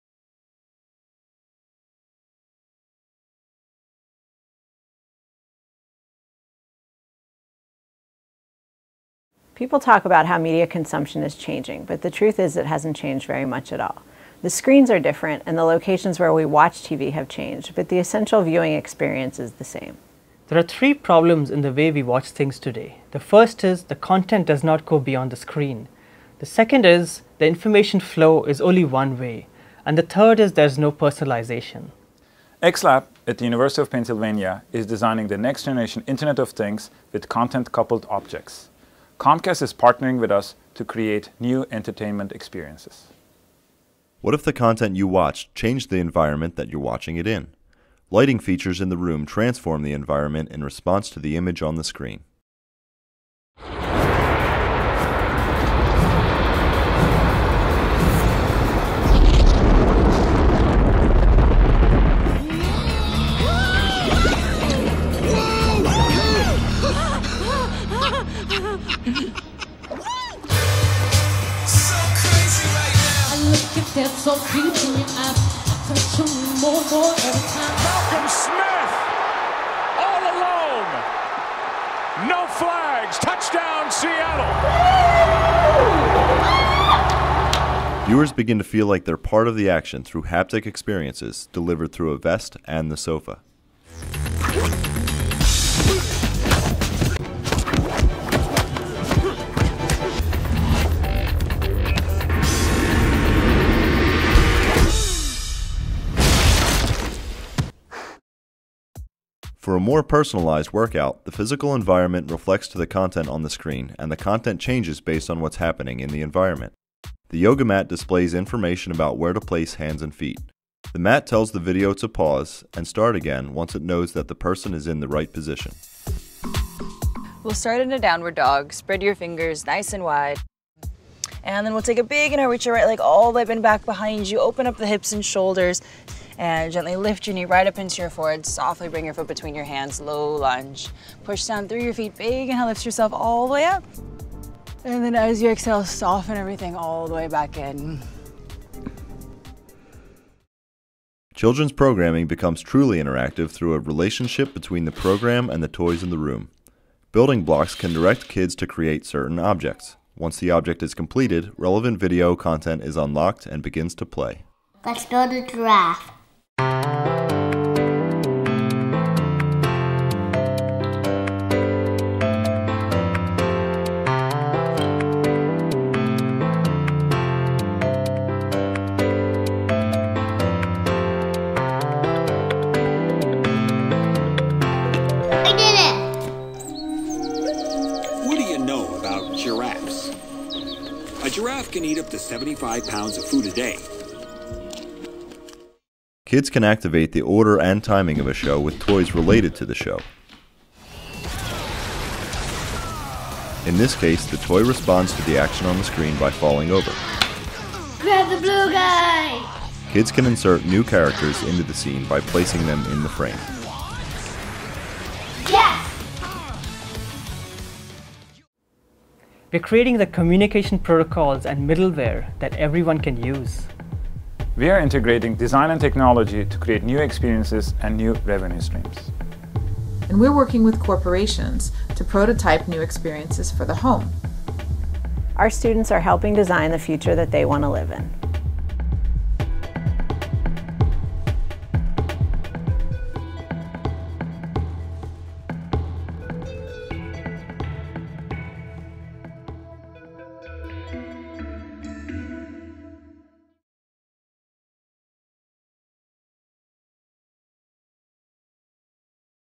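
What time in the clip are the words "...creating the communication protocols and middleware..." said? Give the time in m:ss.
3:39.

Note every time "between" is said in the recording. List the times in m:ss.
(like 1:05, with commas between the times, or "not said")
2:19, 2:34.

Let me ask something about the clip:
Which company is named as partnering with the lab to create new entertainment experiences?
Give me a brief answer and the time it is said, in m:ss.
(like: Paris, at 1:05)
Comcast, at 0:39.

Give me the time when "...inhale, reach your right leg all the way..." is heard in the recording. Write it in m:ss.
2:12.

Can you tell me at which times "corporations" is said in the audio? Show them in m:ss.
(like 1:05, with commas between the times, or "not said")
3:50.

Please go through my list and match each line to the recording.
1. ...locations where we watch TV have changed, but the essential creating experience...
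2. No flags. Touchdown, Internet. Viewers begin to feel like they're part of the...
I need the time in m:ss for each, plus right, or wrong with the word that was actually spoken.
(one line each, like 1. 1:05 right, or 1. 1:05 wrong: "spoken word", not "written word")
1. 0:15 wrong: "viewing", not "creating"
2. 1:22 wrong: "Seattle", not "Internet".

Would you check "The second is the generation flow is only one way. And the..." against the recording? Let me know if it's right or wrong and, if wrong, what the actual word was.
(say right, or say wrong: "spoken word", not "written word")
wrong: "information", not "generation".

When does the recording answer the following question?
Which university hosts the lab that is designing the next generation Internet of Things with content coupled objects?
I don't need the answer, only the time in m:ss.
0:33.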